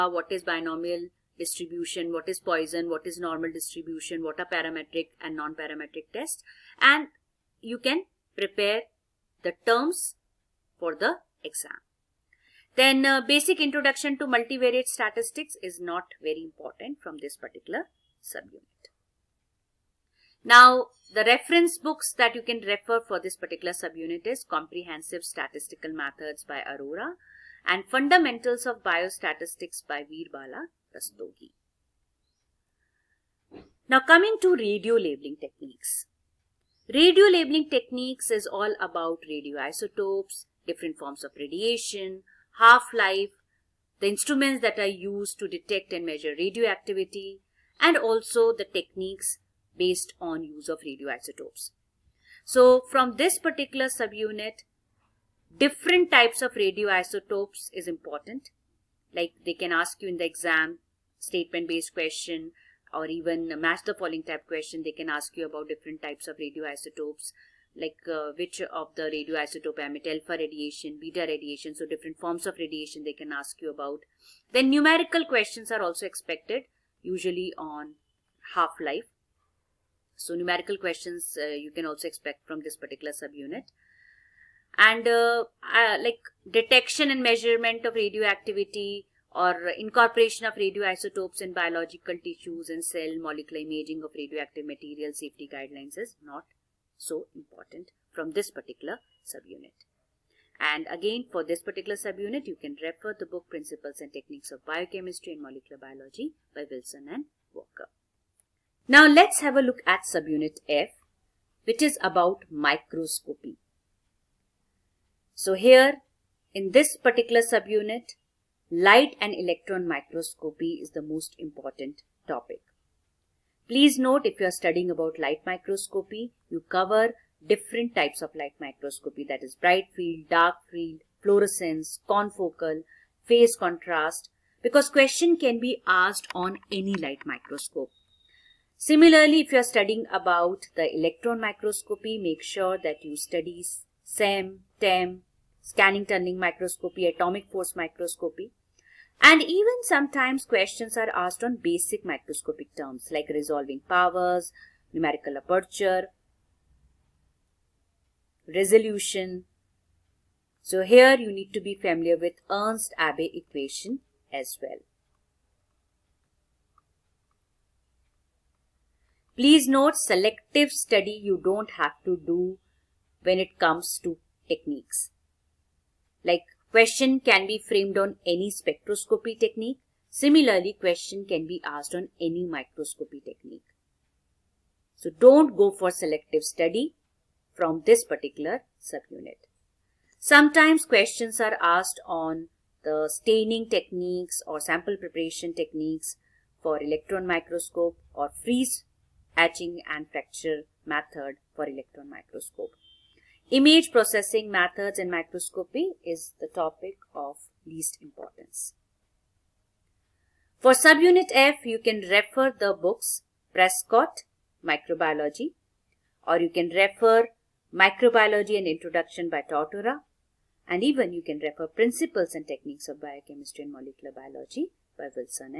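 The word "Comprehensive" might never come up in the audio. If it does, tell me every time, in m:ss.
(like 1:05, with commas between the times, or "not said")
0:24.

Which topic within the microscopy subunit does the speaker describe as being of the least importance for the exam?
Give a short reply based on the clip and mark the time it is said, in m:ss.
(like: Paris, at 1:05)
Image processing methods, at 3:23.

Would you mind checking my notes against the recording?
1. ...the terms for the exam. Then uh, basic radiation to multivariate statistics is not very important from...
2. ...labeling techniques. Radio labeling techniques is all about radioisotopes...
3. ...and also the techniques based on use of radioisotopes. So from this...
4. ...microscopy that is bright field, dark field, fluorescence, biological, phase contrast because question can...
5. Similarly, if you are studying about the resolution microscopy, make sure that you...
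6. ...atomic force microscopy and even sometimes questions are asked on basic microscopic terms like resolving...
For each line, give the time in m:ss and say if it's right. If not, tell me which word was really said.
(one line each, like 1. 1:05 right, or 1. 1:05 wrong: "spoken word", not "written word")
1. 0:09 wrong: "introduction", not "radiation"
2. 0:34 right
3. 0:47 right
4. 2:08 wrong: "confocal", not "biological"
5. 2:18 wrong: "electron", not "resolution"
6. 2:27 right.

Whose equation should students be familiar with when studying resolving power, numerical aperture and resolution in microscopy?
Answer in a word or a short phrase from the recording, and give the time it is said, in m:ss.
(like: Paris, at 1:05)
Ernst Abbe, at 2:42.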